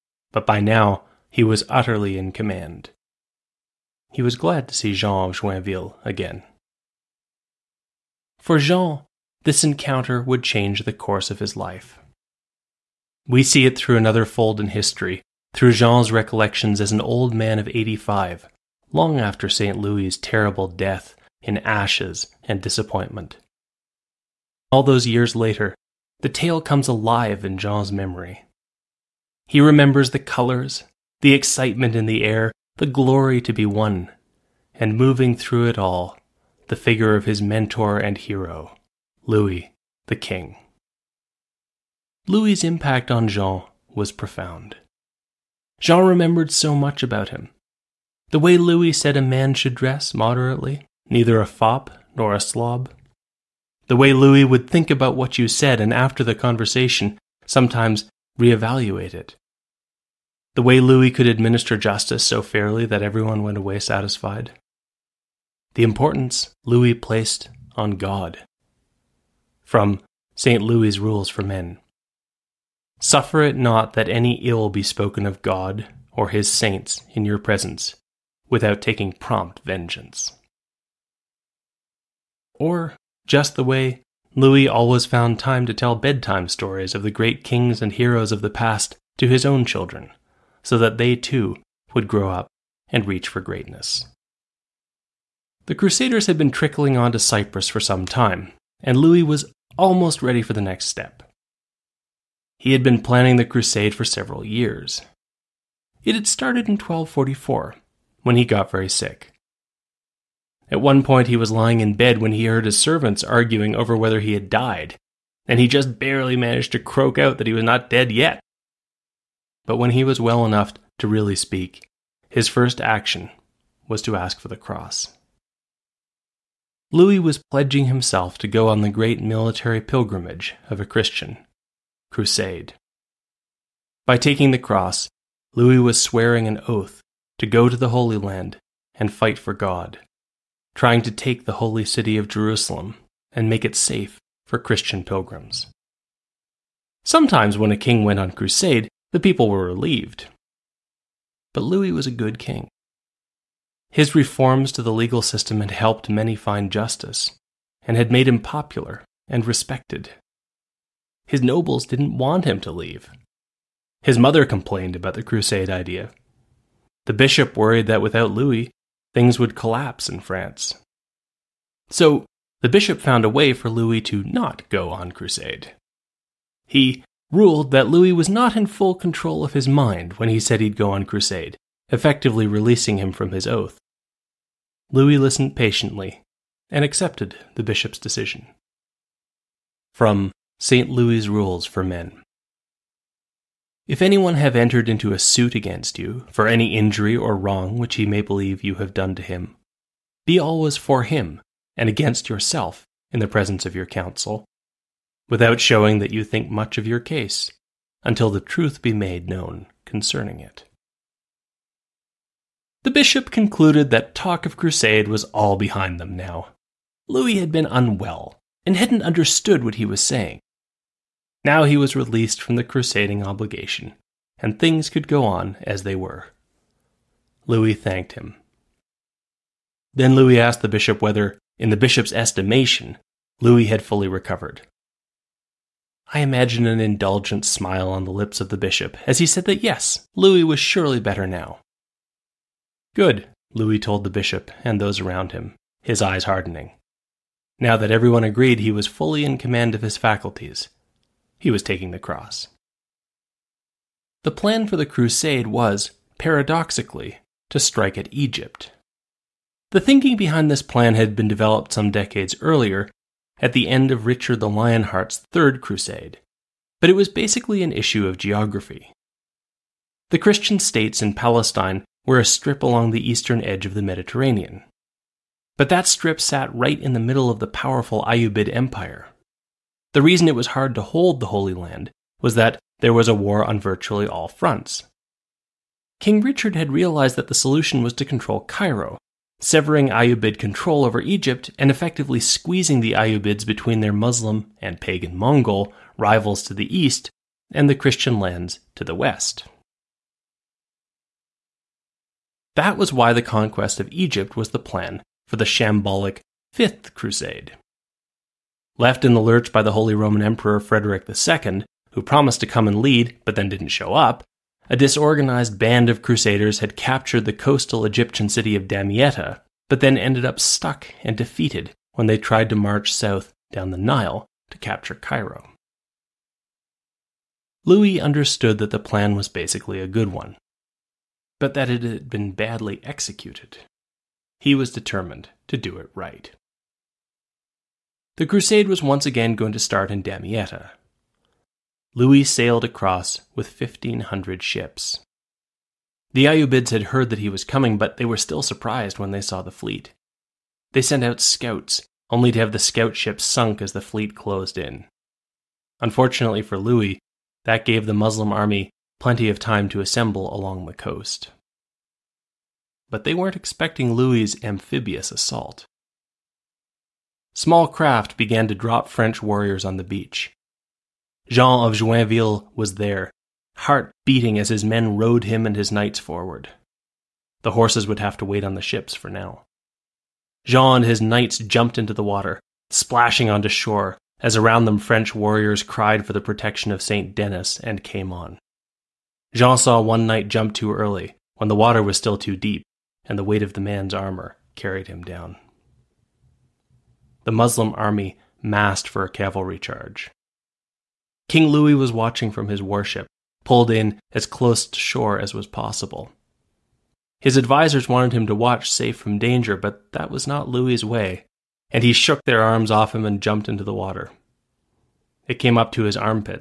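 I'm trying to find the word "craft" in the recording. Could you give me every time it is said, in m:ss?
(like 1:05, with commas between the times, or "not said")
6:07.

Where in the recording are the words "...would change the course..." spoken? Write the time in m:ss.
0:10.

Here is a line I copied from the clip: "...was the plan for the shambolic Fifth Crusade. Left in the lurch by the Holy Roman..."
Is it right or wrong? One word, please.
right.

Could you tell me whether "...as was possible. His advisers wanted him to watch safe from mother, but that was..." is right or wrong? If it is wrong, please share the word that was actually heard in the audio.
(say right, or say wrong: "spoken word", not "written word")
wrong: "danger", not "mother".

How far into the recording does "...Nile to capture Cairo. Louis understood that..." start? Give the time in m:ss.
5:23.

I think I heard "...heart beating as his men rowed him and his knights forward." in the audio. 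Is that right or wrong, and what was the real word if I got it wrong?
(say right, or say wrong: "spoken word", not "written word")
right.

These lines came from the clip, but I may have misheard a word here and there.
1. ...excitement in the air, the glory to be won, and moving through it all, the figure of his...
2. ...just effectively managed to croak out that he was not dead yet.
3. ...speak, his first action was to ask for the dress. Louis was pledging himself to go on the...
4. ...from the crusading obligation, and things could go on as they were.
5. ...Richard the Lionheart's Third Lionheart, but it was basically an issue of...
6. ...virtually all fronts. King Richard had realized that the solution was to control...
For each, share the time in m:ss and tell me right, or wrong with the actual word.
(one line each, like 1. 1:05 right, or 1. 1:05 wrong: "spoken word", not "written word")
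1. 0:31 right
2. 1:55 wrong: "barely", not "effectively"
3. 2:01 wrong: "cross", not "dress"
4. 3:42 right
5. 4:24 wrong: "Crusade", not "Lionheart"
6. 4:43 right.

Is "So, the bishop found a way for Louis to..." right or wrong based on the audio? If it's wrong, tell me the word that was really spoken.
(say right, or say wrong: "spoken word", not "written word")
right.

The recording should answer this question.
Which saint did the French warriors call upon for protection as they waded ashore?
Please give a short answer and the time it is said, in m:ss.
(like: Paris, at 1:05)
St. Denis, at 6:26.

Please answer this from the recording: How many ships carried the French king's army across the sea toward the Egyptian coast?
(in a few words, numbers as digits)
1,500.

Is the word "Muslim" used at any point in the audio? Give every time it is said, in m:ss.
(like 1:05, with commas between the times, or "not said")
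4:53, 5:57, 6:37.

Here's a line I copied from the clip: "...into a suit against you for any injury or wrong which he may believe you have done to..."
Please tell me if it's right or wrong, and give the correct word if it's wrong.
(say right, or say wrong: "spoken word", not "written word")
right.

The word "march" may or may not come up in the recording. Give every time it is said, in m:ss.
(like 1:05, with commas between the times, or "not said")
5:22.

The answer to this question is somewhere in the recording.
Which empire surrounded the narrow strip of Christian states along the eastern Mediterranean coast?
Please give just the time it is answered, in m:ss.
4:38.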